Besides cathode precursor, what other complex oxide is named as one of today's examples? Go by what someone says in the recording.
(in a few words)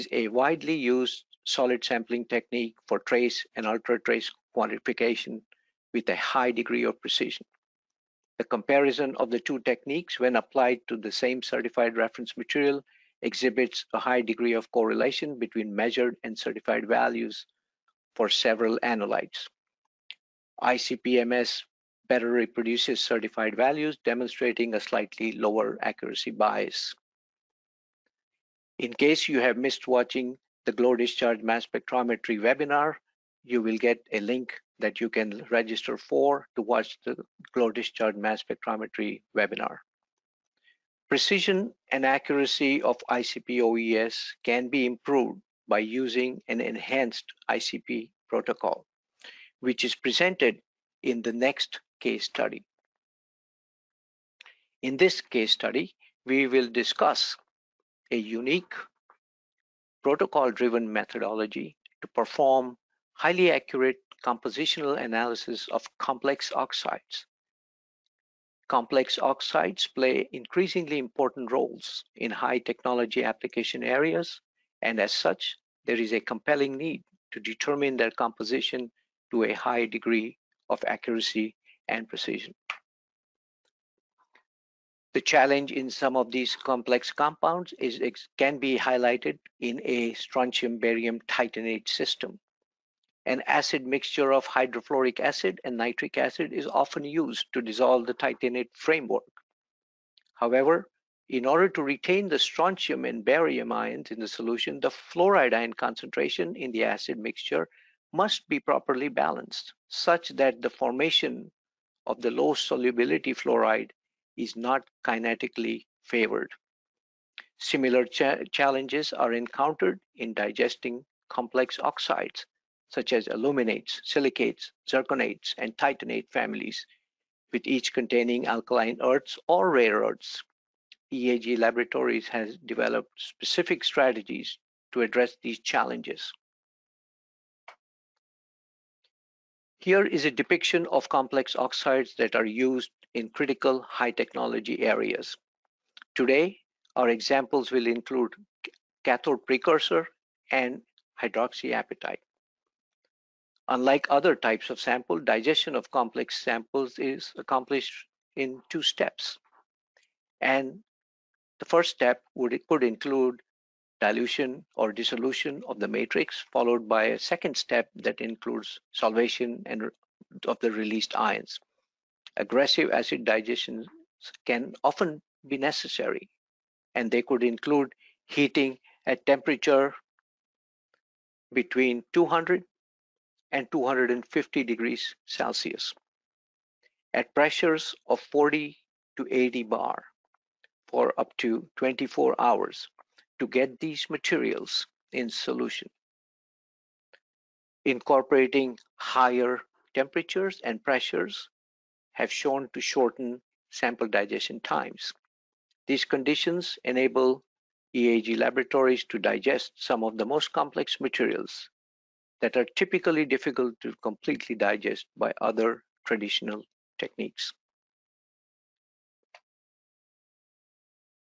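hydroxyapatite.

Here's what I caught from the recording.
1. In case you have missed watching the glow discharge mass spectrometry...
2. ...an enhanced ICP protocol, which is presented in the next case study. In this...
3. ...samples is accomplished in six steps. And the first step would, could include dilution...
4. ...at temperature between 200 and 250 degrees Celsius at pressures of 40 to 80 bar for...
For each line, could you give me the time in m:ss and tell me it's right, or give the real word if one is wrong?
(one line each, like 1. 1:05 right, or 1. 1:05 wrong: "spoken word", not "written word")
1. 0:28 right
2. 0:46 right
3. 2:36 wrong: "two", not "six"
4. 2:59 right.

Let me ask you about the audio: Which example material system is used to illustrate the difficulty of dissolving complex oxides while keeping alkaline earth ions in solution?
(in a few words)
strontium barium titanate.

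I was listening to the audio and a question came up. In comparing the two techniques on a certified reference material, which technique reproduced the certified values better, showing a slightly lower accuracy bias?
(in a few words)
ICP-MS.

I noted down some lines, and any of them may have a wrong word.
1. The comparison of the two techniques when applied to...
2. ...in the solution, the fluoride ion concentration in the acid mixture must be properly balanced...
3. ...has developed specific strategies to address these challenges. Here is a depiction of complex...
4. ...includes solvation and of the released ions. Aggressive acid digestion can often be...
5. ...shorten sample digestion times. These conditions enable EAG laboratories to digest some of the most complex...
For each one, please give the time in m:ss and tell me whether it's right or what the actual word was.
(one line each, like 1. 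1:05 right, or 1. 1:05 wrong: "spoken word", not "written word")
1. 0:08 right
2. 1:44 right
3. 2:12 right
4. 2:48 right
5. 3:22 right.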